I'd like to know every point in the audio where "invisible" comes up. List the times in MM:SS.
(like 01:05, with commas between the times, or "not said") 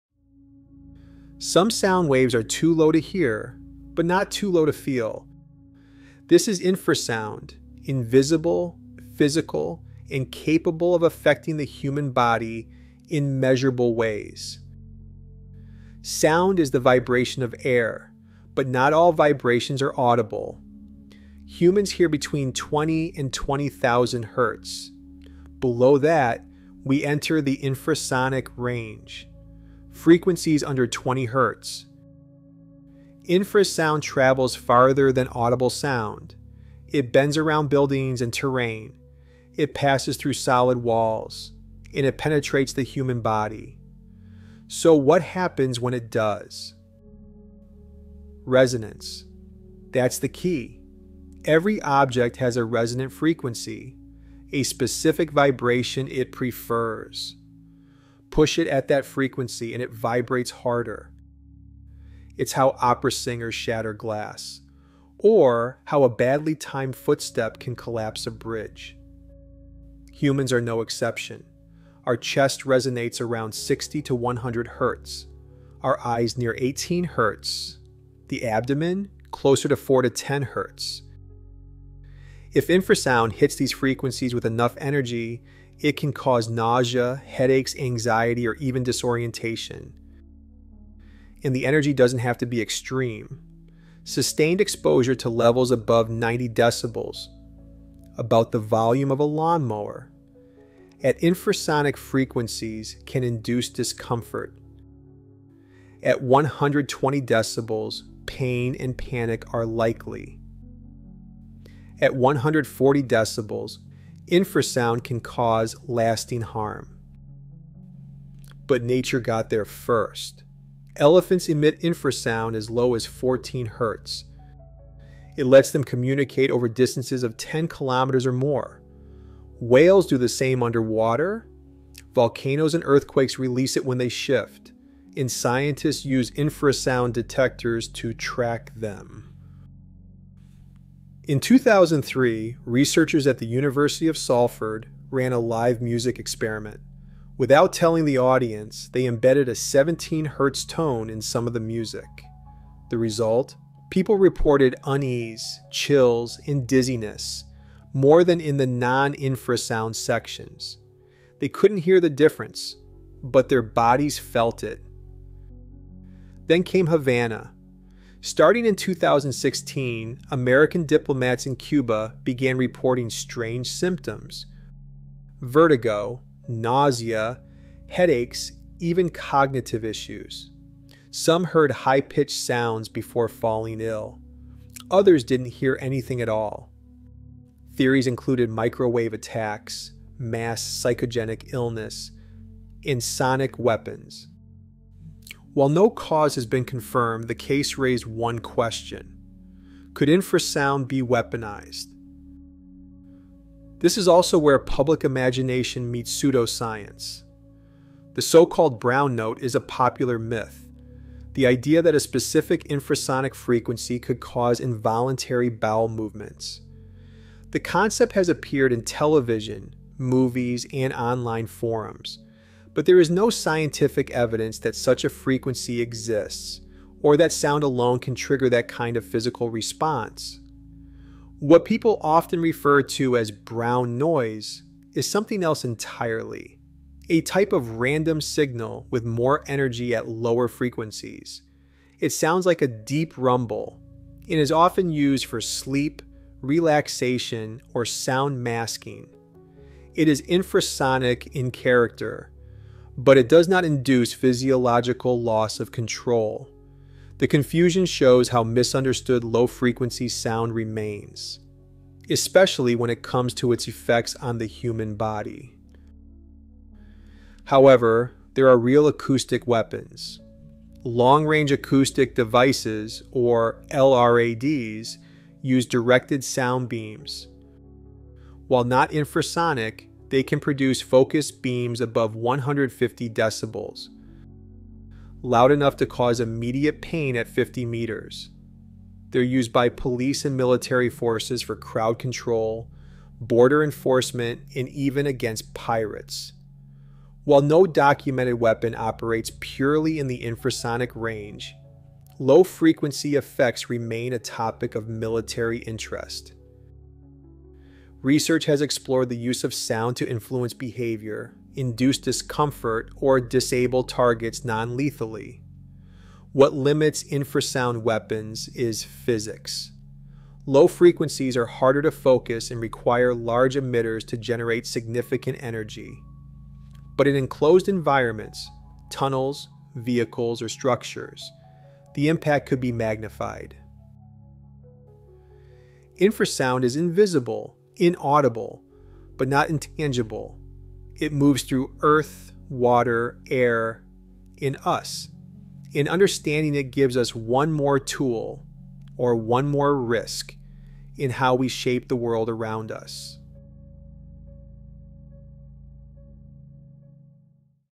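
00:07, 05:36.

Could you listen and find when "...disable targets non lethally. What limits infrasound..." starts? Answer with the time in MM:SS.
05:13.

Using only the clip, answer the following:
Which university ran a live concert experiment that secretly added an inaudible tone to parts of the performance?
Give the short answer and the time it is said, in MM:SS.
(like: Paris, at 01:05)
University of Salford, at 02:23.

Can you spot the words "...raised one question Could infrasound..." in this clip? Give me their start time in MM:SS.
03:17.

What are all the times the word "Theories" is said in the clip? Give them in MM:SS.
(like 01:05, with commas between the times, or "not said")
03:07.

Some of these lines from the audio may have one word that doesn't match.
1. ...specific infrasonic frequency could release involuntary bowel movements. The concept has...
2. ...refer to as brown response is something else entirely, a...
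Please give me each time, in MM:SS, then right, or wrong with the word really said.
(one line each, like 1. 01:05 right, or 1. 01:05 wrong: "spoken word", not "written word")
1. 03:31 wrong: "cause", not "release"
2. 03:52 wrong: "noise", not "response".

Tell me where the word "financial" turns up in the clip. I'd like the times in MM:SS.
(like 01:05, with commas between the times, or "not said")
not said.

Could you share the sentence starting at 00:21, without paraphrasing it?
Humans hear between 20 and 20,000 hertz.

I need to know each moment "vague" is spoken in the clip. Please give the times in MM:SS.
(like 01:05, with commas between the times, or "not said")
not said.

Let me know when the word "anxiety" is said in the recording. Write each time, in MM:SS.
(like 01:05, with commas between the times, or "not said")
01:27.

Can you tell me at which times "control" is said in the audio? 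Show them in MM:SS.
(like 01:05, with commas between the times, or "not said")
04:15, 04:51.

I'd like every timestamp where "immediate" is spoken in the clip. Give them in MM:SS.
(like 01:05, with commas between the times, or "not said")
04:46.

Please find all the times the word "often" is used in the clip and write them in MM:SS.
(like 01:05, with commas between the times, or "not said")
03:52, 04:04.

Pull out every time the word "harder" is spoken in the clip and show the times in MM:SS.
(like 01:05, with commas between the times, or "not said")
01:00, 05:21.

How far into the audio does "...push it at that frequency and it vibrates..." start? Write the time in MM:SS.
00:58.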